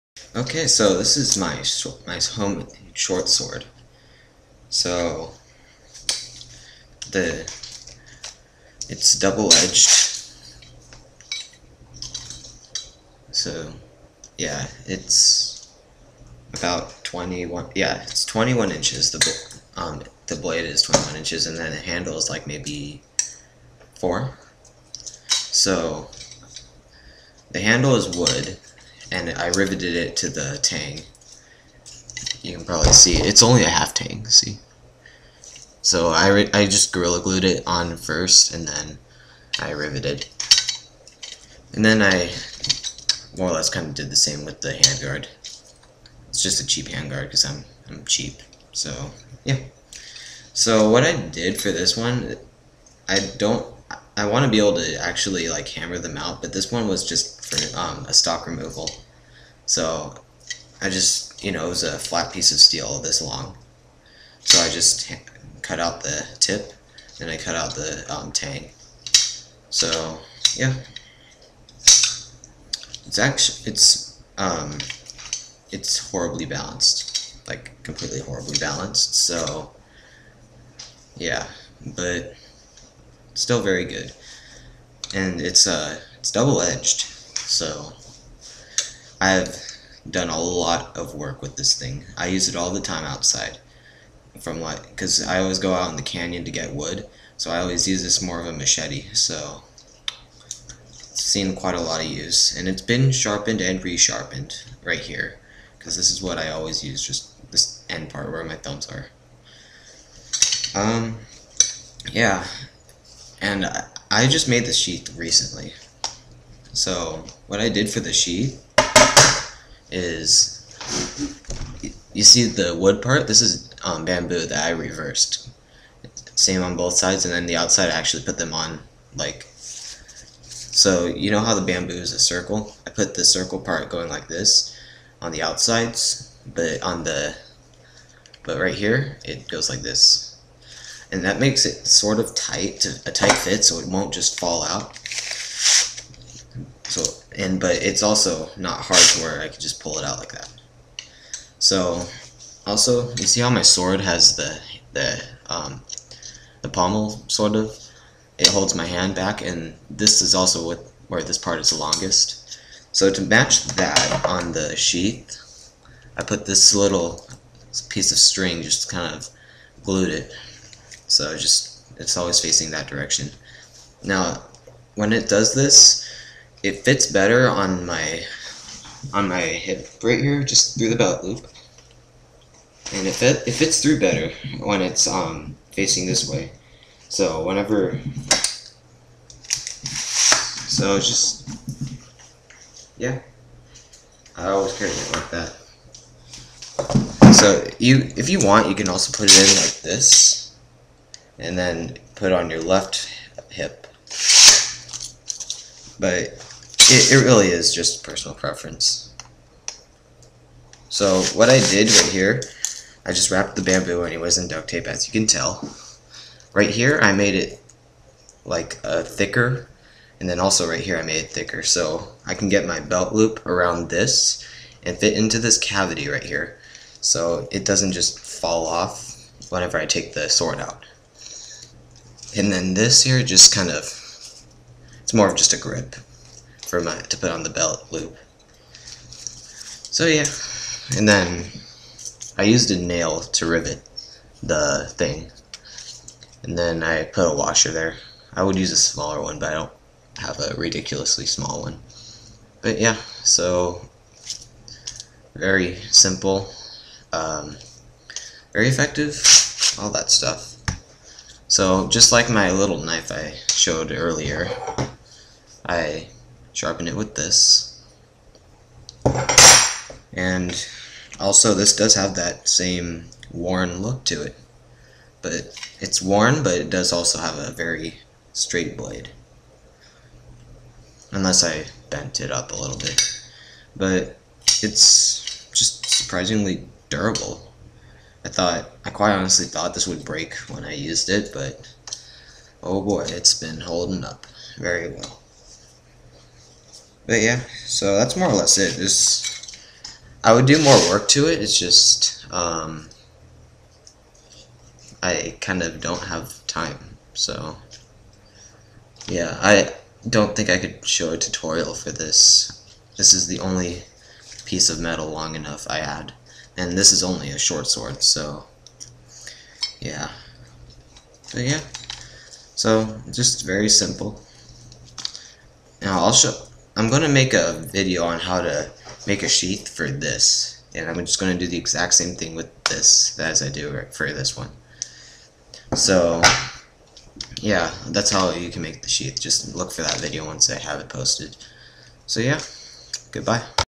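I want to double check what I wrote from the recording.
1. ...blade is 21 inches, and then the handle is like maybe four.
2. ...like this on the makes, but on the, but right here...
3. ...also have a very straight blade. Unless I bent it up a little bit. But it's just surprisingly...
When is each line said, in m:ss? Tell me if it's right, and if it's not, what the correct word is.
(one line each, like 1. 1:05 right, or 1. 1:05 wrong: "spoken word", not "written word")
1. 0:20 right
2. 2:14 wrong: "outsides", not "makes"
3. 4:36 right.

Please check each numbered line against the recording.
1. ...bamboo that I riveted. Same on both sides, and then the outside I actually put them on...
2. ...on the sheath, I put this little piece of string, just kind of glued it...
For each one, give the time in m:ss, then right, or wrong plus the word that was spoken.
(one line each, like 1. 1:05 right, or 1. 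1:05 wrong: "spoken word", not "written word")
1. 2:04 wrong: "reversed", not "riveted"
2. 2:44 right.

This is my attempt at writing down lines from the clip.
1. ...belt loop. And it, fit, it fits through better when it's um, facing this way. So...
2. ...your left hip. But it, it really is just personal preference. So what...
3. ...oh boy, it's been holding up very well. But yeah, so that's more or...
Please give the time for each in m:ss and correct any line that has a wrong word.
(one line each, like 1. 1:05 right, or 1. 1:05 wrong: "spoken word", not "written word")
1. 3:00 right
2. 3:22 right
3. 4:52 right.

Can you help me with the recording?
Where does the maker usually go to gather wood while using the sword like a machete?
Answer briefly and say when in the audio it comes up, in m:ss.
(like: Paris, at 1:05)
the canyon, at 1:35.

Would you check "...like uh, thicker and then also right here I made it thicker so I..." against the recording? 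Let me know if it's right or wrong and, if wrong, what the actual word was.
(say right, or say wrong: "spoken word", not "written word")
right.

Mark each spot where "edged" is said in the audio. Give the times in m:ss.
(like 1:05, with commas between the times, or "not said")
0:09, 1:26.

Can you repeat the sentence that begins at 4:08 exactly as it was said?
I would use a smaller one, but I don't have a ridiculously small one.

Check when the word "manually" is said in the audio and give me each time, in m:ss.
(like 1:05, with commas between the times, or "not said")
not said.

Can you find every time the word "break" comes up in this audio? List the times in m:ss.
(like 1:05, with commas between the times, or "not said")
4:50.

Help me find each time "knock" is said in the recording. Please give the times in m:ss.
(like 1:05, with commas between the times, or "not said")
not said.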